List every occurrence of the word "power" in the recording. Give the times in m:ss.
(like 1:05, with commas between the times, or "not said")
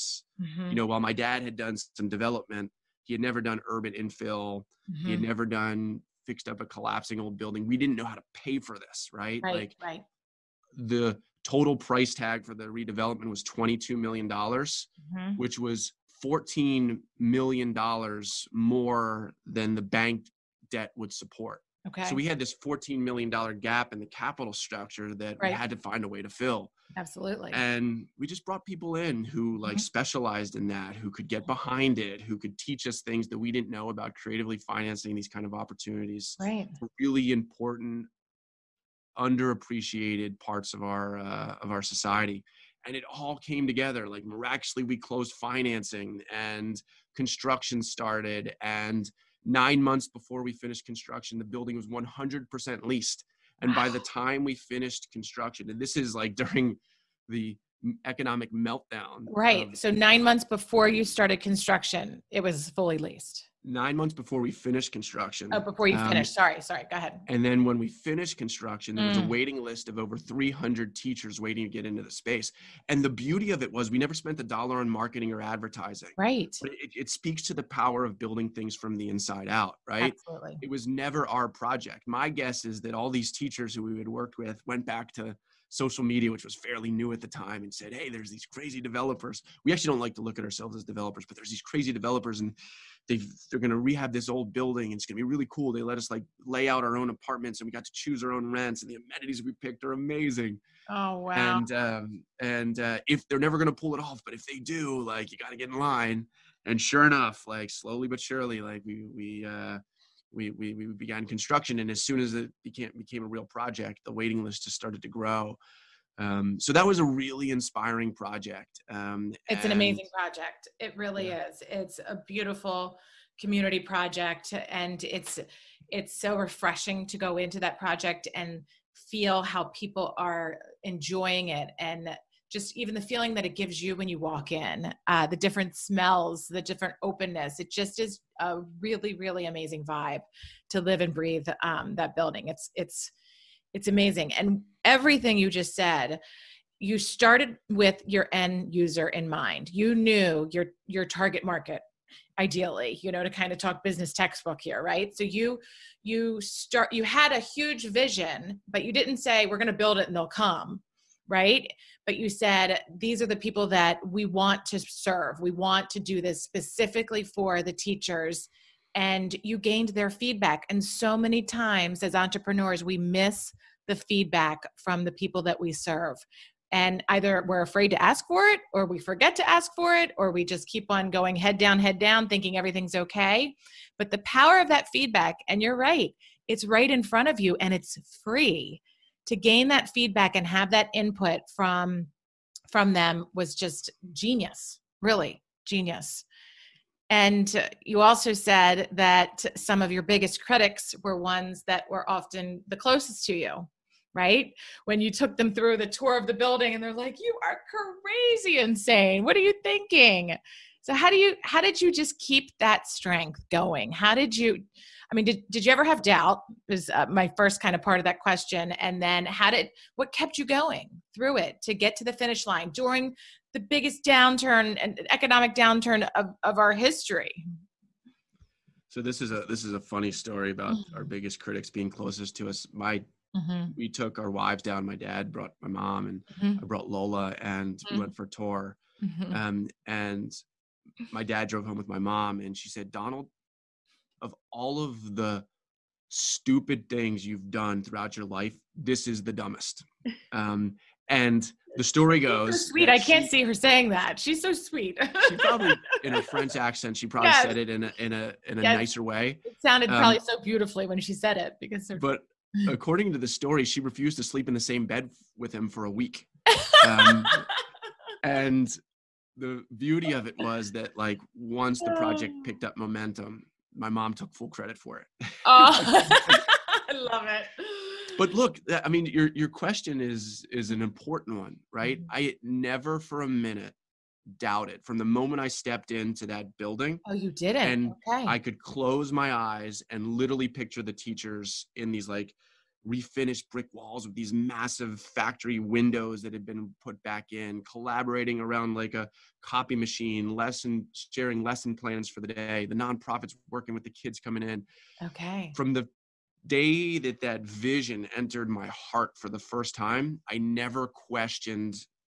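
1:17, 3:04.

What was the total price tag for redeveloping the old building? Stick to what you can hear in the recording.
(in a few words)
$22 million.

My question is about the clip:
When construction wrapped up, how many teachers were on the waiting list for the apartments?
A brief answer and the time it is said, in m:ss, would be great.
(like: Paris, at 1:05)
Over 300, at 1:09.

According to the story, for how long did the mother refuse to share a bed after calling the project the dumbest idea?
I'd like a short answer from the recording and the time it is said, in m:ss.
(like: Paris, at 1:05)
A week, at 4:25.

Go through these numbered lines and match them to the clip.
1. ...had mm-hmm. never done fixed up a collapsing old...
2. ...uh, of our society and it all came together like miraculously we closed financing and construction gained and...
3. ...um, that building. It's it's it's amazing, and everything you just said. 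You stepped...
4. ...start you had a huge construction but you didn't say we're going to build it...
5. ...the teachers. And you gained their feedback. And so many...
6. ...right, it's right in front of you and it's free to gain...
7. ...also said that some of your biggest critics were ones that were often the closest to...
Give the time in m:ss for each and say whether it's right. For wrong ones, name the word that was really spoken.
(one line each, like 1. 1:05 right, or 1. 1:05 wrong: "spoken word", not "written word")
1. 0:05 right
2. 0:41 wrong: "started", not "gained"
3. 2:21 wrong: "started", not "stepped"
4. 2:36 wrong: "vision", not "construction"
5. 2:47 right
6. 3:05 right
7. 3:17 right.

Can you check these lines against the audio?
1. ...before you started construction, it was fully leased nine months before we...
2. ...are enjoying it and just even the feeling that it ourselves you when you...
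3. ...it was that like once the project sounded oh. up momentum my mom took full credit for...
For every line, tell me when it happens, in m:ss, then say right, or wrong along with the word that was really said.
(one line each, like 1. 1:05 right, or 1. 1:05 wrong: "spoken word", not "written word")
1. 1:00 right
2. 2:10 wrong: "gives", not "ourselves"
3. 4:30 wrong: "picked", not "sounded".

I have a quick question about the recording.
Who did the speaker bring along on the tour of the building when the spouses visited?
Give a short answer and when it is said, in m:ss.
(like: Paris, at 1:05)
Lola, at 3:56.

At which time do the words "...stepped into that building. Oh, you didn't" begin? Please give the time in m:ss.
4:45.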